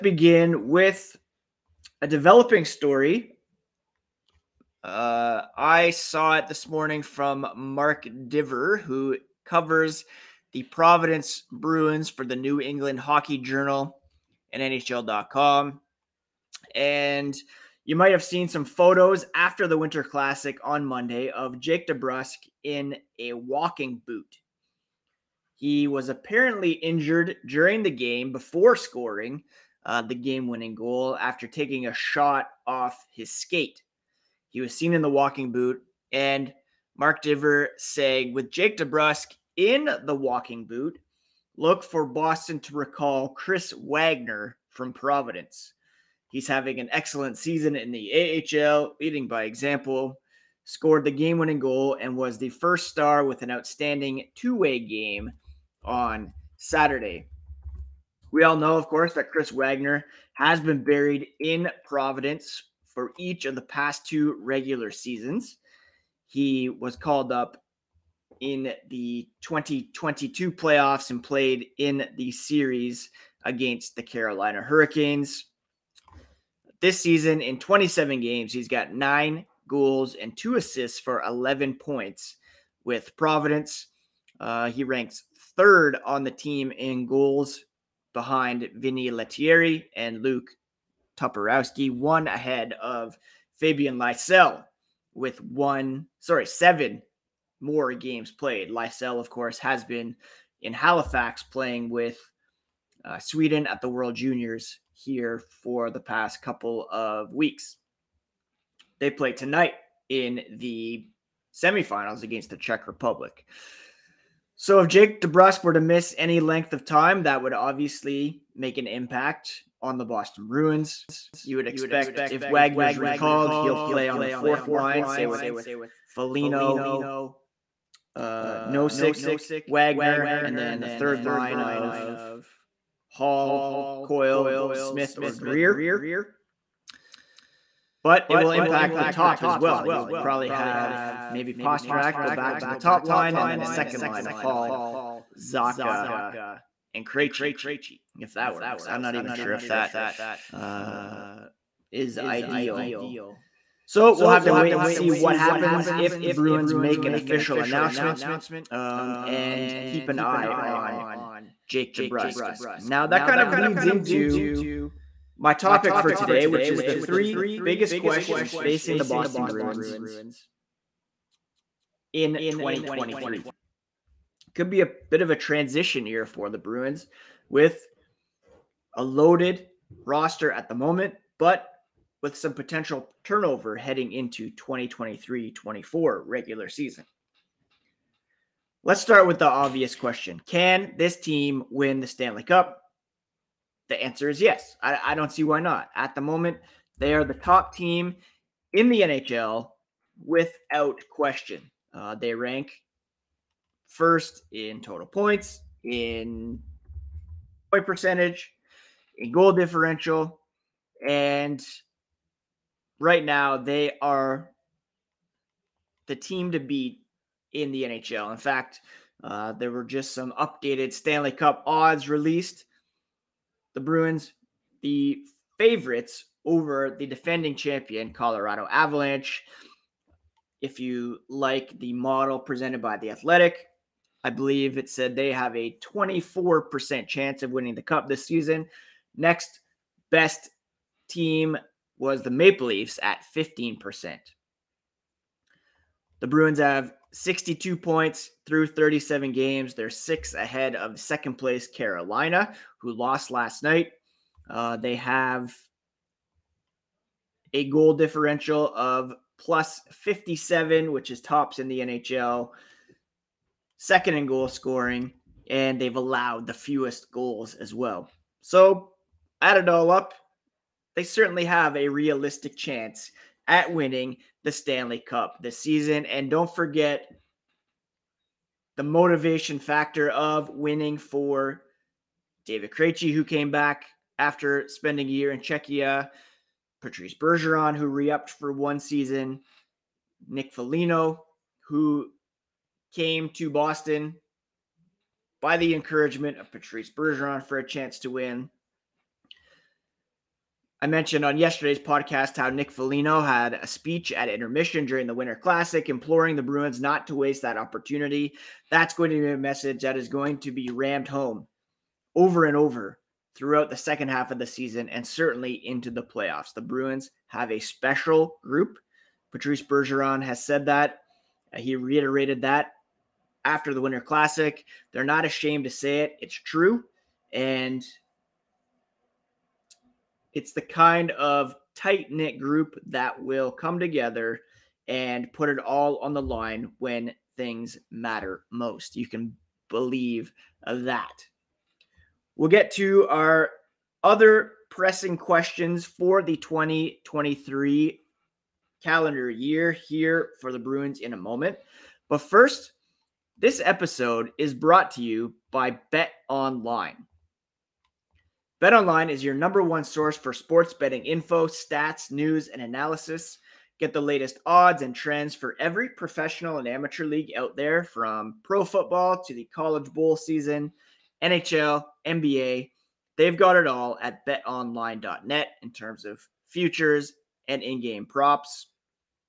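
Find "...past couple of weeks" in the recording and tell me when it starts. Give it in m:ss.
1:45.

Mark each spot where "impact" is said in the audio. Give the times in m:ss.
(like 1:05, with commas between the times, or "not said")
1:58, 2:18.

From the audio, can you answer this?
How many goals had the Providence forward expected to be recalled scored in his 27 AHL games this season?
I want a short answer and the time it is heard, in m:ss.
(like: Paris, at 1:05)
9, at 1:18.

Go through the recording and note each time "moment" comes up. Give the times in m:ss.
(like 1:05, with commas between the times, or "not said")
3:00, 3:16, 5:51.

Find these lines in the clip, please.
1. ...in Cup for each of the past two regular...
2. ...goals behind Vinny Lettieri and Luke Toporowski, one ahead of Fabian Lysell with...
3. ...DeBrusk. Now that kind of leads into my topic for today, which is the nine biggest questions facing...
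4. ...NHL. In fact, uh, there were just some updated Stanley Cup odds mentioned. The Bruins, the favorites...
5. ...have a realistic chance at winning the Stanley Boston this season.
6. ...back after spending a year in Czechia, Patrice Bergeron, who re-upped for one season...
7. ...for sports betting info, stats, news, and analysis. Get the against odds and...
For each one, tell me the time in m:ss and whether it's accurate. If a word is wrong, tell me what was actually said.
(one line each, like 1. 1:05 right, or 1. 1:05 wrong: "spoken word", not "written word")
1. 1:01 wrong: "Providence", not "Cup"
2. 1:27 right
3. 2:41 wrong: "three", not "nine"
4. 3:37 wrong: "released", not "mentioned"
5. 4:31 wrong: "Cup", not "Boston"
6. 4:43 right
7. 6:00 wrong: "latest", not "against".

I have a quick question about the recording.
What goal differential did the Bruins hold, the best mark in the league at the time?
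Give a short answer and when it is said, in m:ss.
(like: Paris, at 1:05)
plus 57, at 4:19.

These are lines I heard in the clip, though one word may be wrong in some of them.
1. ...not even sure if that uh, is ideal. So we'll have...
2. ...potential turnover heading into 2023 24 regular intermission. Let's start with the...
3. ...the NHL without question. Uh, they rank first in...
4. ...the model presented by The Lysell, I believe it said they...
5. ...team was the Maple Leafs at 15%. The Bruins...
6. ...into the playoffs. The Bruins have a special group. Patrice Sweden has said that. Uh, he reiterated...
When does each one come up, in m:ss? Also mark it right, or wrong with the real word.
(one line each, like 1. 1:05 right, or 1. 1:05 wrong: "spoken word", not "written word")
1. 2:29 right
2. 3:02 wrong: "season", not "intermission"
3. 3:18 right
4. 3:51 wrong: "Athletic", not "Lysell"
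5. 4:01 right
6. 5:15 wrong: "Bergeron", not "Sweden".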